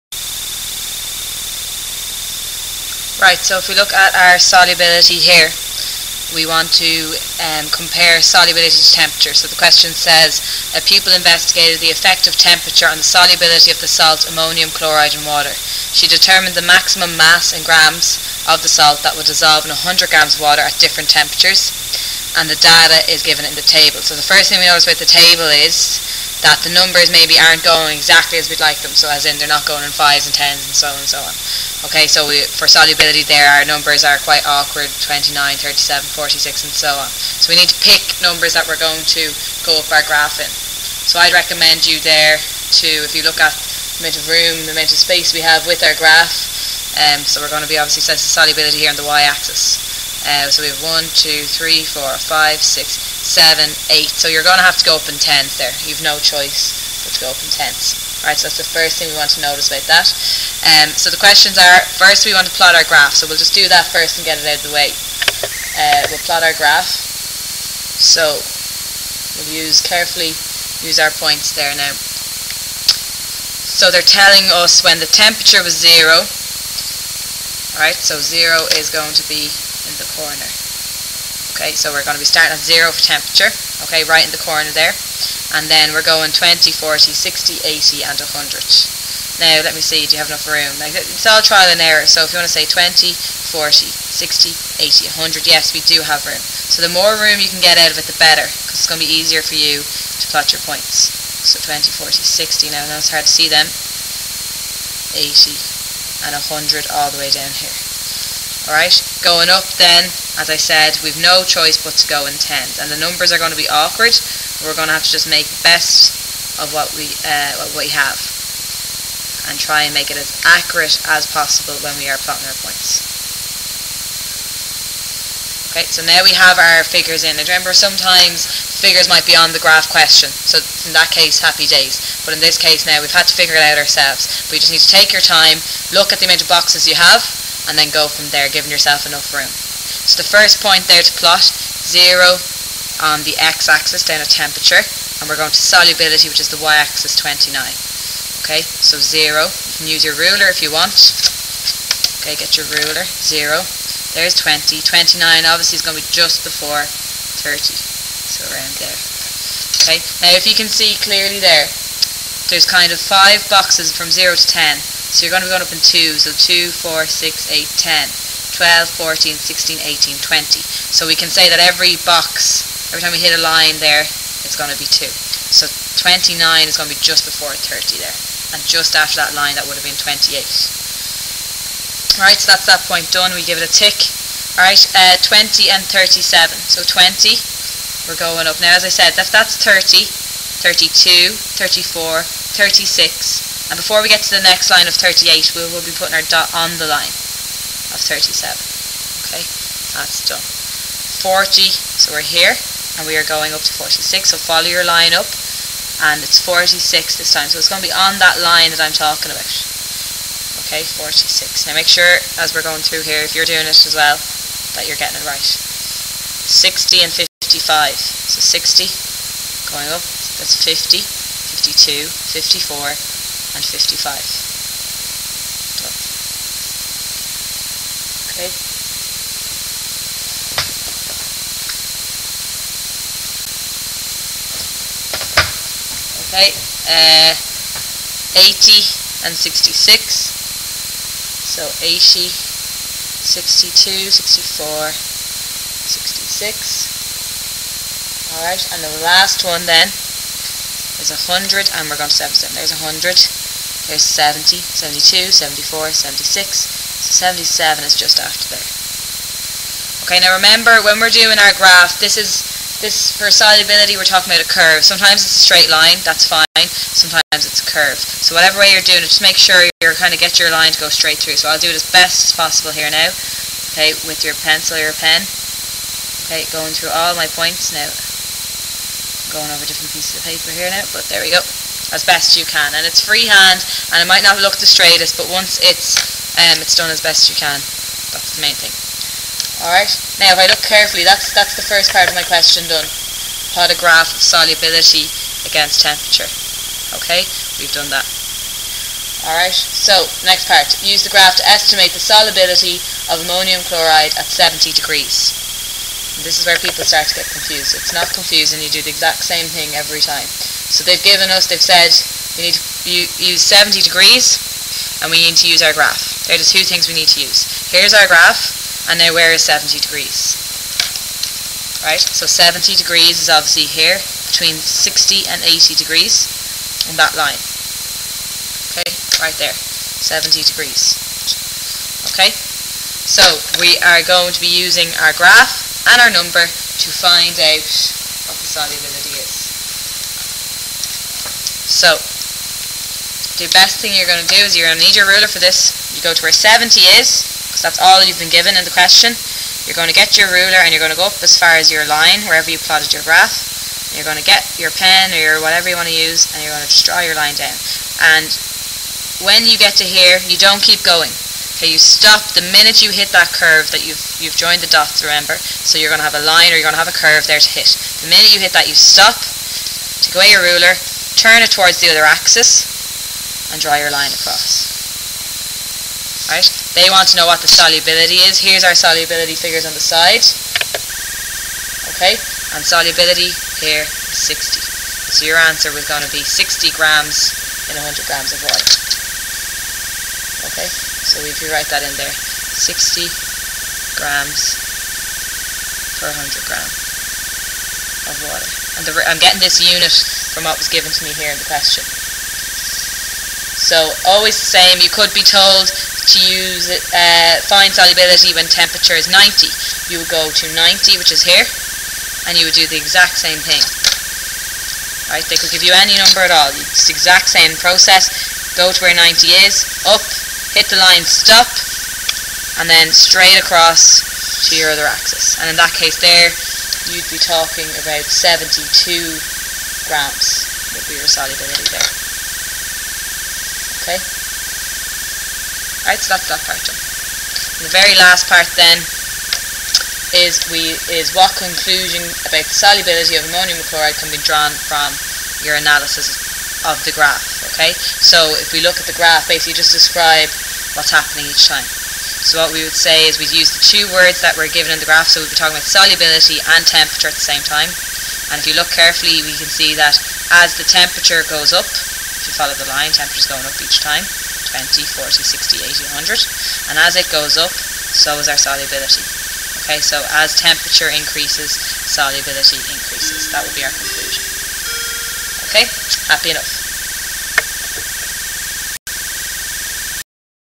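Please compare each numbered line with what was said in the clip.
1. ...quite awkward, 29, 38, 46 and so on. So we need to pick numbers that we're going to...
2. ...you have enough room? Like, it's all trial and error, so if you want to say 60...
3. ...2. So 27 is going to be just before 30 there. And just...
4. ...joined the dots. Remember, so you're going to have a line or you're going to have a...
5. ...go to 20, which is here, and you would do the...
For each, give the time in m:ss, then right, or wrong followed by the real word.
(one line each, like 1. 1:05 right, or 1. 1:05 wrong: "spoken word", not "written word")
1. 0:34 wrong: "37", not "38"
2. 1:30 wrong: "20", not "60"
3. 2:54 wrong: "29", not "27"
4. 6:04 right
5. 6:50 wrong: "90", not "20".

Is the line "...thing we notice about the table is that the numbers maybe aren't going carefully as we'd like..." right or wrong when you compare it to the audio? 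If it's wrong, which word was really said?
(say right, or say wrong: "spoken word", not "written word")
wrong: "exactly", not "carefully".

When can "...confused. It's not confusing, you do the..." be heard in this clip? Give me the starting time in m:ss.
5:07.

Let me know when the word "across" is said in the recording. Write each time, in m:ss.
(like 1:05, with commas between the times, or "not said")
6:14, 7:03.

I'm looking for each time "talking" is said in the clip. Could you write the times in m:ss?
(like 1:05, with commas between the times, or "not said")
3:28, 4:24, 7:07, 7:35.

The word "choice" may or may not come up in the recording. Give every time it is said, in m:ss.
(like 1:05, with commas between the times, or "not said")
0:56, 1:51.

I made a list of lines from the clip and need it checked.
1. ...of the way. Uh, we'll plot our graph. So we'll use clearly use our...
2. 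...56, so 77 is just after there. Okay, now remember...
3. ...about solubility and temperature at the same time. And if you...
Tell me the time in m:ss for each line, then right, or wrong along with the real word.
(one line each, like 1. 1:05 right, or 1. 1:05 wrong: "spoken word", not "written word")
1. 1:04 wrong: "carefully", not "clearly"
2. 4:15 wrong: "76", not "56"
3. 7:35 right.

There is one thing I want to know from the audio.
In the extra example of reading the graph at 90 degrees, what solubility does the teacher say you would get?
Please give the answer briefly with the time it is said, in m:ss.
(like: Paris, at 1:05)
72 grams, at 7:08.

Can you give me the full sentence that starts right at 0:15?
She determined the maximum mass in grams of the salt that would dissolve in 100 grams of water at different temperatures.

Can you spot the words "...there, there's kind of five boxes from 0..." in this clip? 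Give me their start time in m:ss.
2:41.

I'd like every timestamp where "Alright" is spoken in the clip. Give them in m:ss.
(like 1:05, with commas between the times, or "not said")
0:58, 1:17, 1:48, 4:08, 4:49, 4:59, 7:15.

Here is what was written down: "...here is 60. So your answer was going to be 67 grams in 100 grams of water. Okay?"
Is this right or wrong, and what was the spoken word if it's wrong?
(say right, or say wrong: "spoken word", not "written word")
wrong: "60", not "67".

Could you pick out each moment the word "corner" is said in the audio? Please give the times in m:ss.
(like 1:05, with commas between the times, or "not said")
1:20, 1:24.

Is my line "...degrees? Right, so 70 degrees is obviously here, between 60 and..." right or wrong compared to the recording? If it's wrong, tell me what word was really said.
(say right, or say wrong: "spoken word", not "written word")
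right.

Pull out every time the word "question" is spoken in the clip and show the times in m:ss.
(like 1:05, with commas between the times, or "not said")
0:09, 1:01, 2:09, 4:52, 5:48, 6:41.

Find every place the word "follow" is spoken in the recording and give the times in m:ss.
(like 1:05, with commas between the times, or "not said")
3:24, 7:42.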